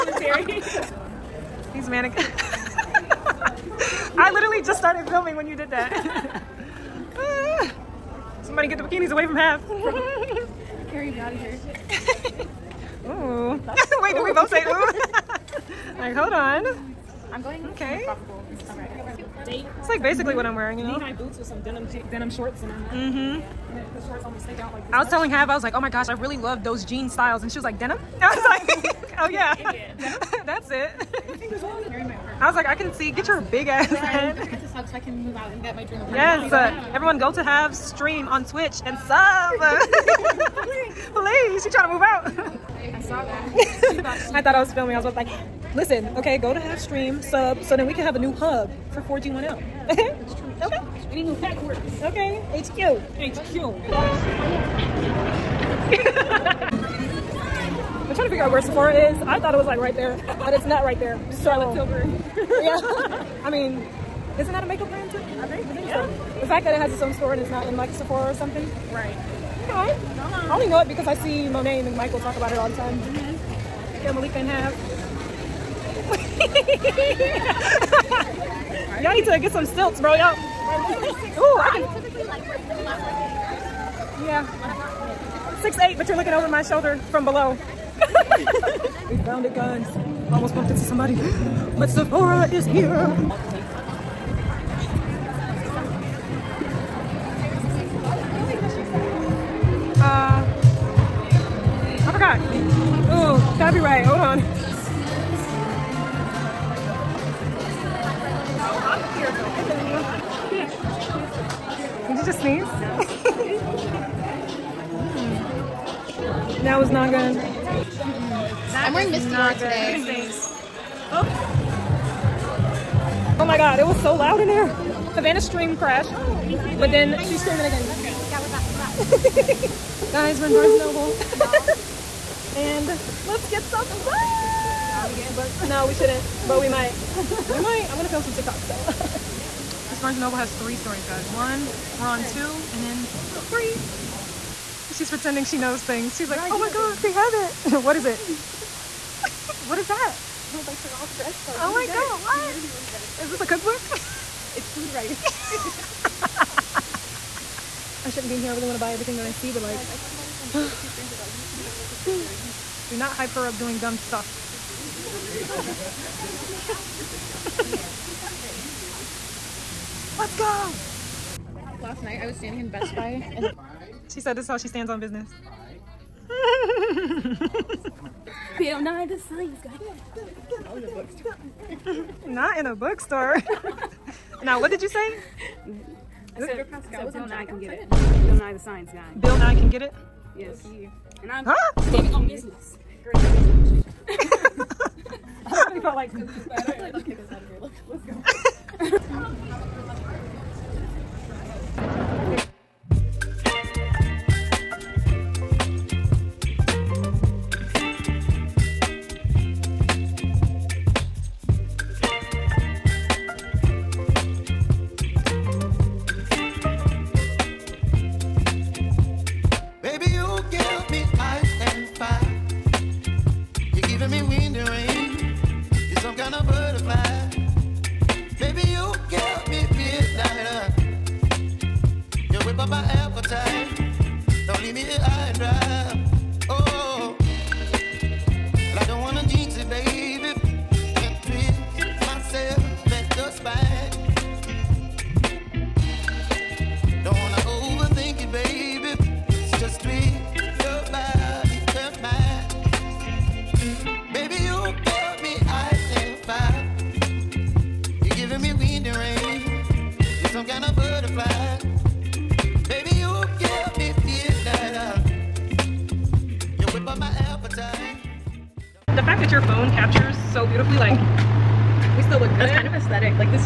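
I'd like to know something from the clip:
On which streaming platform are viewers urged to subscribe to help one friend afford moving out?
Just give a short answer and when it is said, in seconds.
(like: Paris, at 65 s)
Twitch, at 38 s.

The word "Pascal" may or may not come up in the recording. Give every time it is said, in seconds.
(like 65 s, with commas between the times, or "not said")
186 s.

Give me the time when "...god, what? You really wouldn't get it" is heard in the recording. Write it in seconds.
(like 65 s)
151 s.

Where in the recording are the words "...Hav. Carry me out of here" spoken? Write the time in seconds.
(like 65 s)
9 s.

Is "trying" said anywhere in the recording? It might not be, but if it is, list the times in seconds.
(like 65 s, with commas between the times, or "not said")
41 s, 58 s.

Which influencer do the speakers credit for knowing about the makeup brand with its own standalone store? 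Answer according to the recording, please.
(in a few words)
Monet McMichael.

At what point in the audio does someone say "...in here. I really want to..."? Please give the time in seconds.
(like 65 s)
158 s.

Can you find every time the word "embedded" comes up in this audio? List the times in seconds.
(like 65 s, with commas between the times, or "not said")
not said.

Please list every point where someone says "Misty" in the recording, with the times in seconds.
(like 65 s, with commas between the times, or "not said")
119 s.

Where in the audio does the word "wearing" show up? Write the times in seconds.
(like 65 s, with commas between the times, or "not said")
20 s, 118 s.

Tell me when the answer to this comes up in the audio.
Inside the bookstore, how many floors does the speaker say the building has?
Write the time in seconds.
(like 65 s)
140 s.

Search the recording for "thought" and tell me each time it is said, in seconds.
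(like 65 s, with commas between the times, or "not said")
44 s, 59 s.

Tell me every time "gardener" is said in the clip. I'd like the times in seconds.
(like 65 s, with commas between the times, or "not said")
not said.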